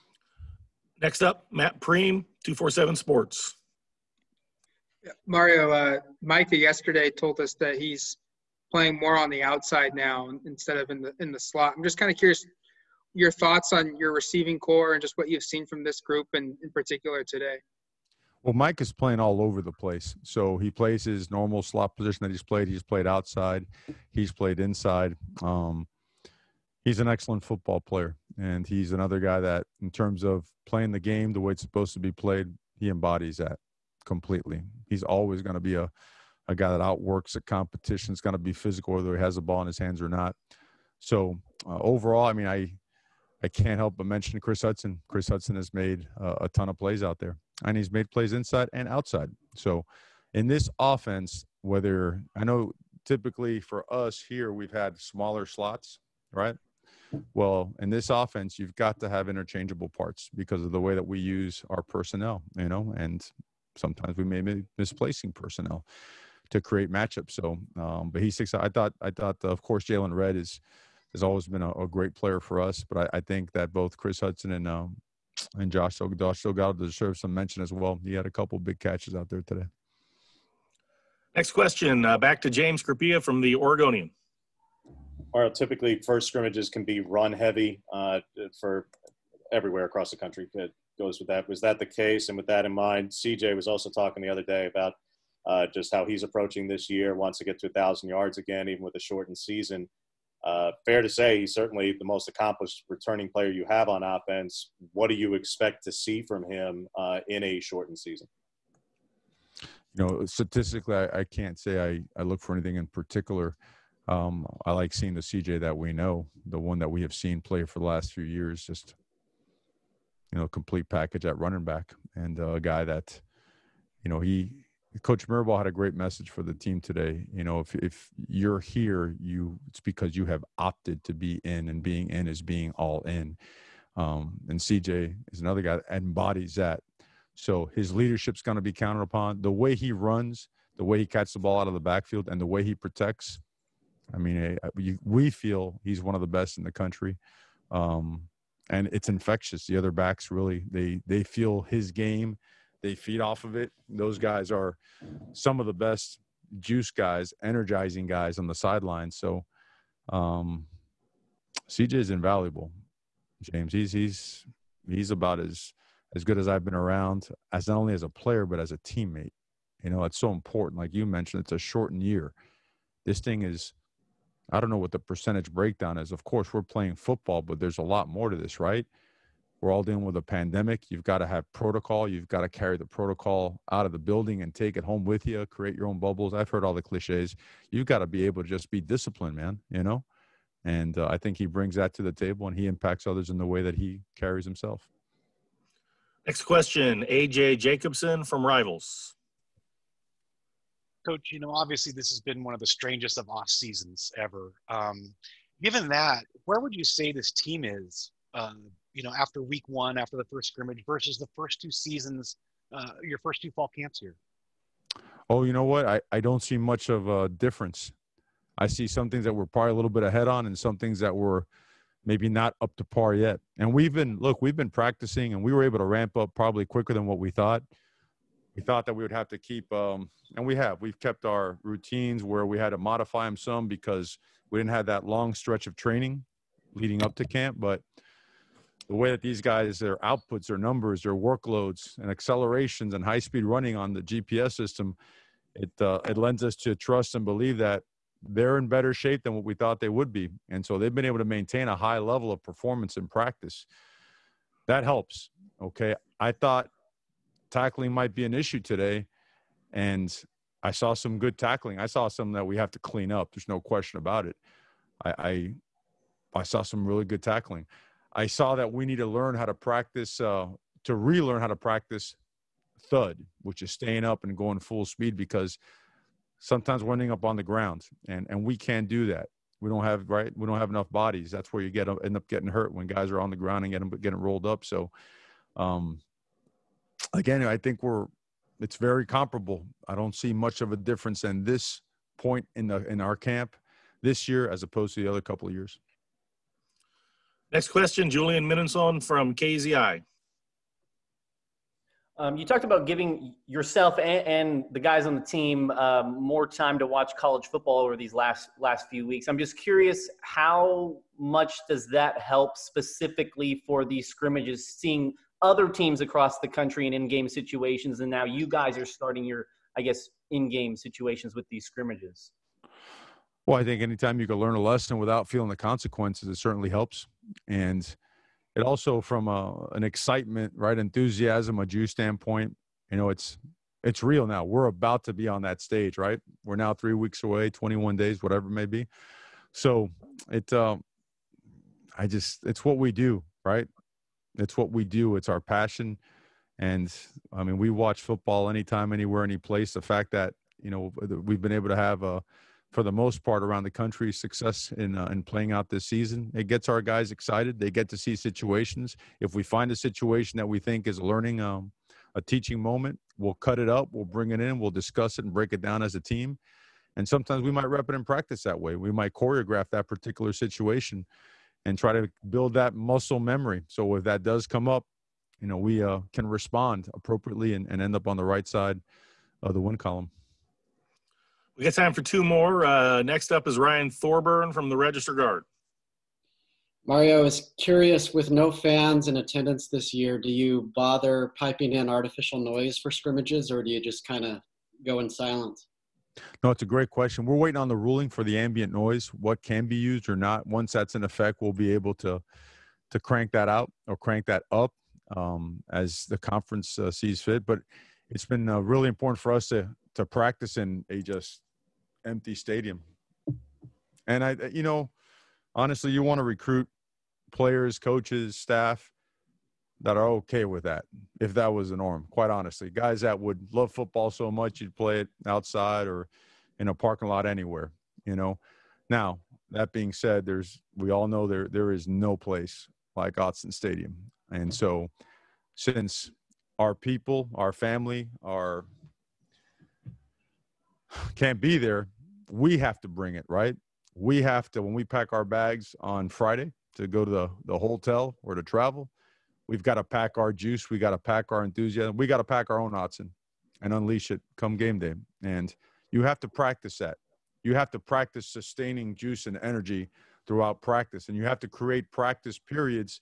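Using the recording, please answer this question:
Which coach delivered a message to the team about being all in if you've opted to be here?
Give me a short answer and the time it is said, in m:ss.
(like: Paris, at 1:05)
Coach Mirabal, at 2:05.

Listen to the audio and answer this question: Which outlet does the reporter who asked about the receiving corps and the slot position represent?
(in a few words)
247 Sports.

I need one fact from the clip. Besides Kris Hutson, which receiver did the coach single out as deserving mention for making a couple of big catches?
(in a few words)
Josh Delgado.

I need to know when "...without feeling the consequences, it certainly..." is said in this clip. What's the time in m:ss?
5:24.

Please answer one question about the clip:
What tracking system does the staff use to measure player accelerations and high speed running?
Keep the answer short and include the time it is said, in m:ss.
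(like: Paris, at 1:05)
GPS, at 4:04.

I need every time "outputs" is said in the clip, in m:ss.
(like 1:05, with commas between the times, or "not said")
3:59.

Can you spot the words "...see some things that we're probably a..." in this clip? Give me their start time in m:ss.
3:38.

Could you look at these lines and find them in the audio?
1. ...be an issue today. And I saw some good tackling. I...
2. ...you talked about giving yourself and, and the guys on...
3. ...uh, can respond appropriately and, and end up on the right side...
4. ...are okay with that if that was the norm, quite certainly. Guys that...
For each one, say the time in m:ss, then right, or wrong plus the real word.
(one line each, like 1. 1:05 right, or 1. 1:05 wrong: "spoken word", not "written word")
1. 4:18 right
2. 5:02 right
3. 6:15 right
4. 6:59 wrong: "honestly", not "certainly".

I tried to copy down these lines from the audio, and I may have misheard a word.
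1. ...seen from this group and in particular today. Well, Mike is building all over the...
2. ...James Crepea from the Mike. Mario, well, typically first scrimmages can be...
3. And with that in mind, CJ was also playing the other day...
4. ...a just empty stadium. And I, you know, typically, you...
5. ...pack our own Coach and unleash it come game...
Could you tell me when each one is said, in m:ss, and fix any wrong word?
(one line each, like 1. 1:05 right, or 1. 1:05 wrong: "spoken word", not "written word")
1. 0:15 wrong: "playing", not "building"
2. 1:22 wrong: "Oregonian", not "Mike"
3. 1:32 wrong: "talking", not "playing"
4. 6:50 wrong: "honestly", not "typically"
5. 7:32 wrong: "Autzen", not "Coach".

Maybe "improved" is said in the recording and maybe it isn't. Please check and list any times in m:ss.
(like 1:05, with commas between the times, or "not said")
not said.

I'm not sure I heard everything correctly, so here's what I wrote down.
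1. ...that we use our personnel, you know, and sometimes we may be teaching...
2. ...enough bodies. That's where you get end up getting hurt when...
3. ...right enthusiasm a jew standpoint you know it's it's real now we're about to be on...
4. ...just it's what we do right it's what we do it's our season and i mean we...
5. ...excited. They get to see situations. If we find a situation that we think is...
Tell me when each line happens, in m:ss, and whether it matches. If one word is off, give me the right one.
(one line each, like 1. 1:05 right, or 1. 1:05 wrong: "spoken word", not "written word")
1. 1:00 wrong: "misplacing", not "teaching"
2. 4:40 right
3. 5:30 right
4. 5:42 wrong: "passion", not "season"
5. 5:57 right.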